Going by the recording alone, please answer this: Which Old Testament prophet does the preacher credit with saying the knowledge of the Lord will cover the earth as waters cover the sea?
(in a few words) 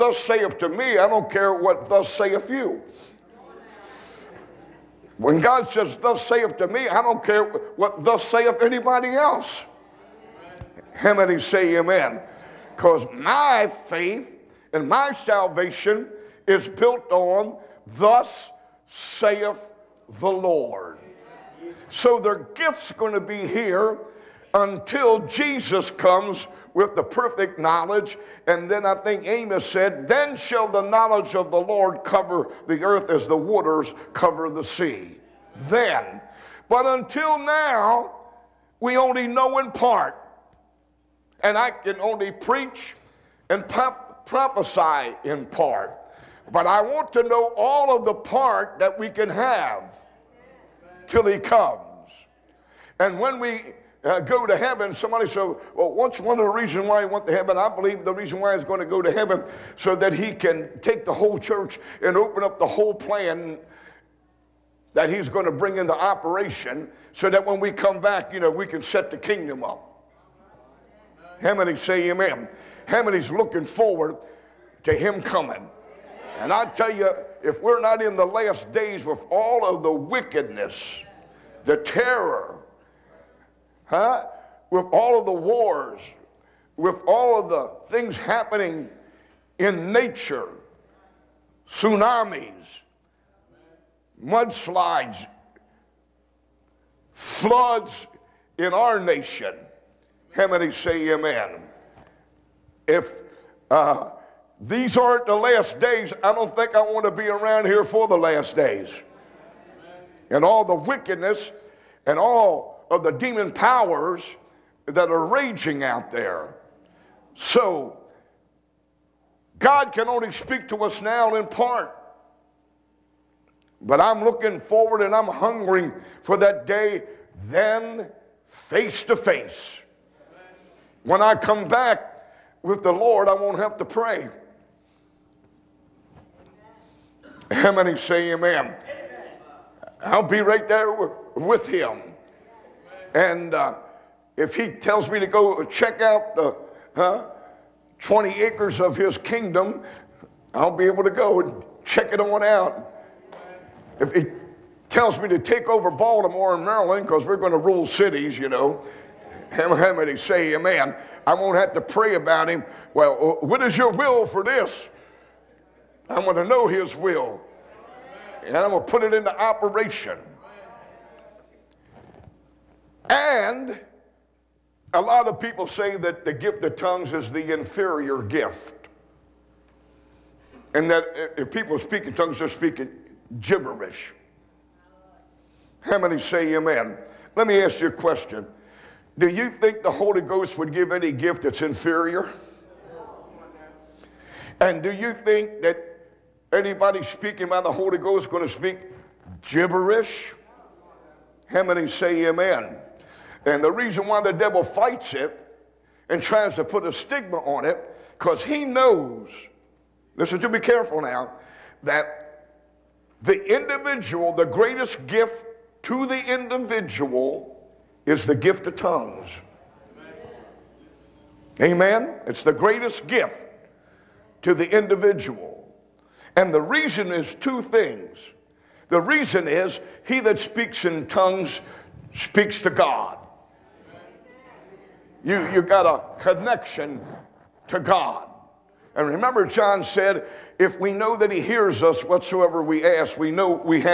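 Amos.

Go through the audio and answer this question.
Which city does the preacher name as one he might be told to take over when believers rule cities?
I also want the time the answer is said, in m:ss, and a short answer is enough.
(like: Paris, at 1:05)
Baltimore, at 2:35.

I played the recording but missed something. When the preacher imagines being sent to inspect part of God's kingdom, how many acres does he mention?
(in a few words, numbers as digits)
20.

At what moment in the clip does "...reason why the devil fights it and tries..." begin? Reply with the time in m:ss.
3:23.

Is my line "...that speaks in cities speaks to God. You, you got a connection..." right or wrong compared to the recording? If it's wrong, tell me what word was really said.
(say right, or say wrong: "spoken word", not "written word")
wrong: "tongues", not "cities".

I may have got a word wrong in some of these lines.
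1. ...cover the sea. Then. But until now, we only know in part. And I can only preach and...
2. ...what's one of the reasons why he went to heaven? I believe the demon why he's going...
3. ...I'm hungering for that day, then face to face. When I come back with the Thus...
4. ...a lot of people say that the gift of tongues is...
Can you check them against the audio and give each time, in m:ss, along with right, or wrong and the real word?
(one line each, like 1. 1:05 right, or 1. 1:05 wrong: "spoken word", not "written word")
1. 0:34 right
2. 0:55 wrong: "reason", not "demon"
3. 2:05 wrong: "Lord", not "Thus"
4. 2:54 right.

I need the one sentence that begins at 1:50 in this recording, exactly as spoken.
And all the wickedness and all of the demon powers that are raging out there.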